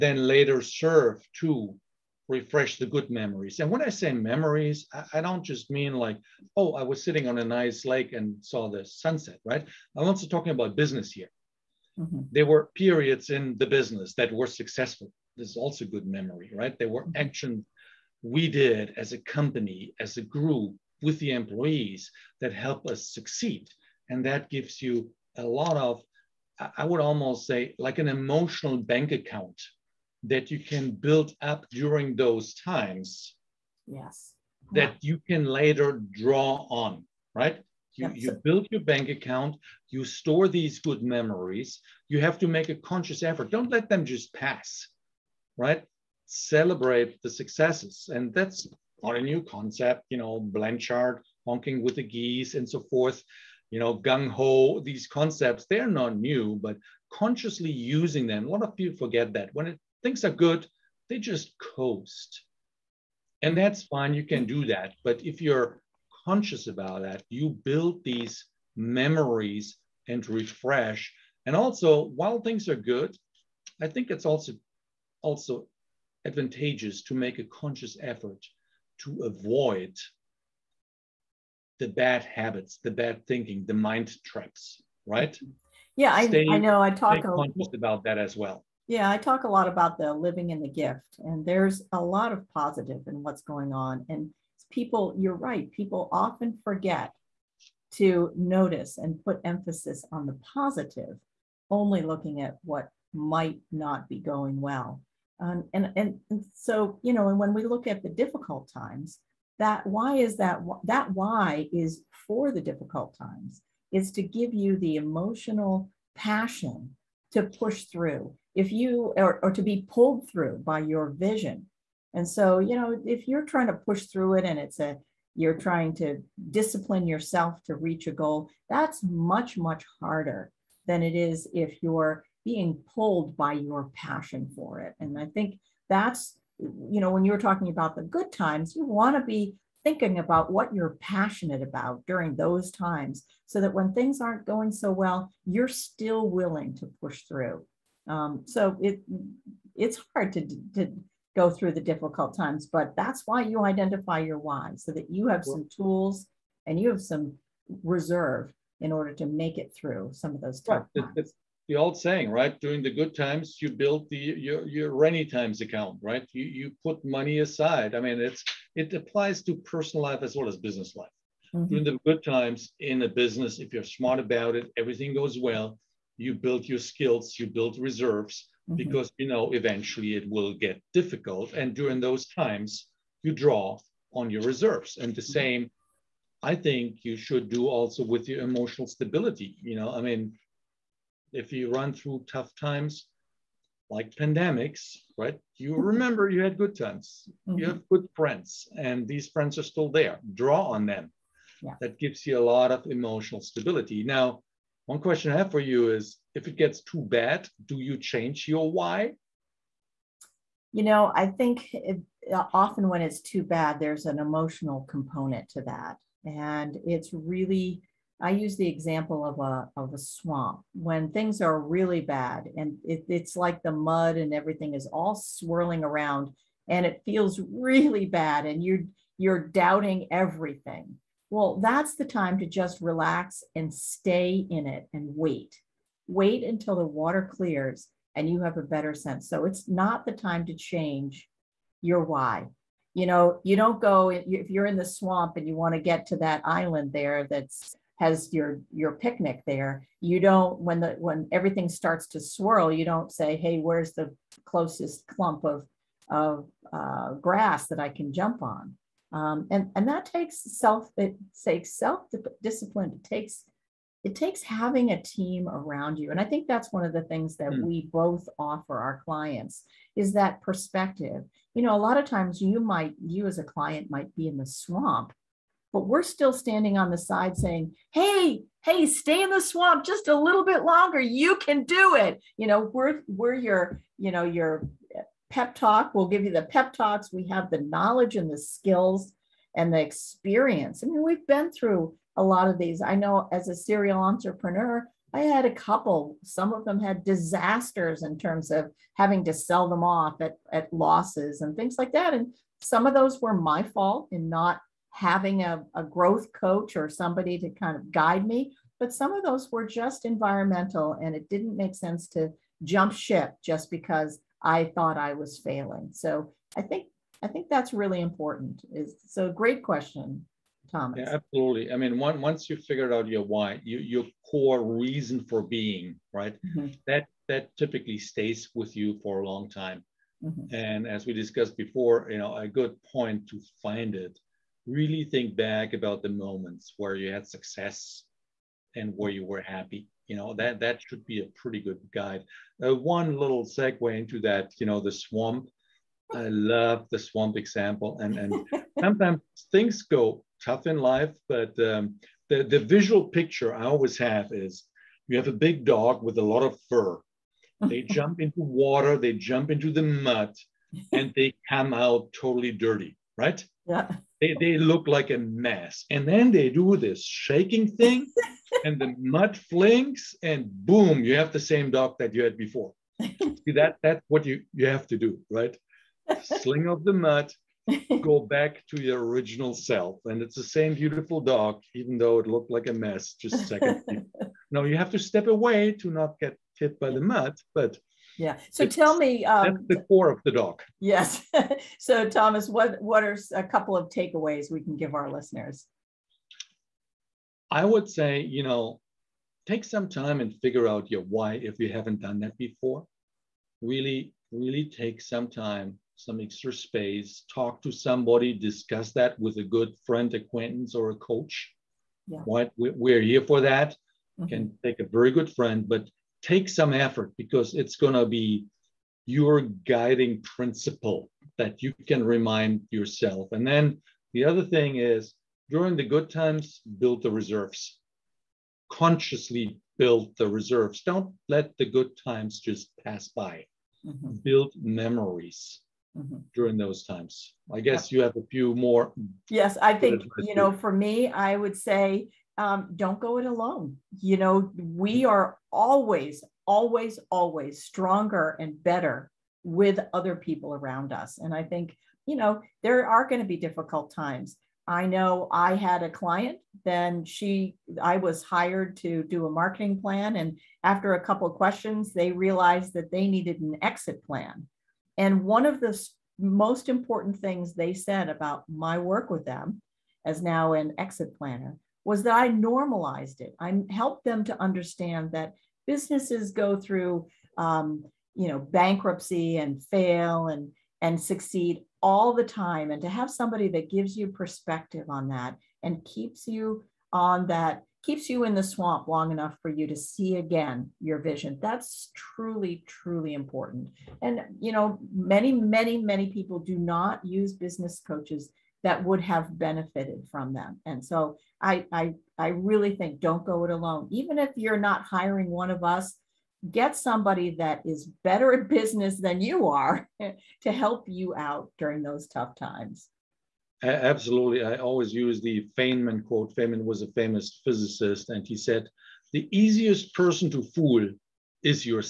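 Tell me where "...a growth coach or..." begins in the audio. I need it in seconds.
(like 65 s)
305 s.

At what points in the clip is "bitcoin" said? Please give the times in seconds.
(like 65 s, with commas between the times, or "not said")
not said.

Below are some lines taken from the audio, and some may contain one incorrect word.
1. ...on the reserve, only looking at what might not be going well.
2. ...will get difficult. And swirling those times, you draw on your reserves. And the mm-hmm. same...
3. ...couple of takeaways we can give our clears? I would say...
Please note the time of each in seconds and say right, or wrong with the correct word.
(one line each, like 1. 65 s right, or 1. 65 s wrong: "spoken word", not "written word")
1. 100 s wrong: "positive", not "reserve"
2. 180 s wrong: "during", not "swirling"
3. 393 s wrong: "listeners", not "clears".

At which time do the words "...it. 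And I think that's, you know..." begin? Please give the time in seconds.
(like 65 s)
134 s.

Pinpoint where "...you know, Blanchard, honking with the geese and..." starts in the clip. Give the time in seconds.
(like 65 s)
50 s.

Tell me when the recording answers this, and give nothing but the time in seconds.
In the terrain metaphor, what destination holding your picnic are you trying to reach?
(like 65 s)
246 s.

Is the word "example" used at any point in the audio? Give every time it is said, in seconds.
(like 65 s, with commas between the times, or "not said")
218 s, 347 s.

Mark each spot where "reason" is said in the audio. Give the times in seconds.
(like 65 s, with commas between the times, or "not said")
324 s.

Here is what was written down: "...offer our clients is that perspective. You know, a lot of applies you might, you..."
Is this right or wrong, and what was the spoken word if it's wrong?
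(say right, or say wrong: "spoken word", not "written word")
wrong: "times", not "applies".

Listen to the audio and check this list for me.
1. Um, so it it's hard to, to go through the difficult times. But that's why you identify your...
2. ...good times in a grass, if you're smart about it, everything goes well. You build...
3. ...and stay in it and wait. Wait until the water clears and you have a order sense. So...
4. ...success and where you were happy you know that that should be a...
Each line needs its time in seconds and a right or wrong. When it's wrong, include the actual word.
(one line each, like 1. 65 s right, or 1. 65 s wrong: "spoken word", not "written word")
1. 148 s right
2. 172 s wrong: "business", not "grass"
3. 233 s wrong: "better", not "order"
4. 337 s right.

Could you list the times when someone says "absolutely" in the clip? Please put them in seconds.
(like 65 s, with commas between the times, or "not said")
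321 s, 513 s.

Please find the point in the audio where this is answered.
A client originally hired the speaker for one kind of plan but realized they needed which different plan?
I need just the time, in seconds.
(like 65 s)
463 s.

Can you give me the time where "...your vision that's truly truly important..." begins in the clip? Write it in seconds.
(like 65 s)
490 s.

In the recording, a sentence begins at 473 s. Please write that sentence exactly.
I helped them to understand that businesses go through, um, you know, bankruptcy and fail and and succeed all the time.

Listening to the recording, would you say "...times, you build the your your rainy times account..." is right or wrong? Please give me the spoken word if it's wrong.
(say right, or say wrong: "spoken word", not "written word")
right.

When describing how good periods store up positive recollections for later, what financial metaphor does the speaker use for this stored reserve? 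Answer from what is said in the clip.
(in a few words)
emotional bank account.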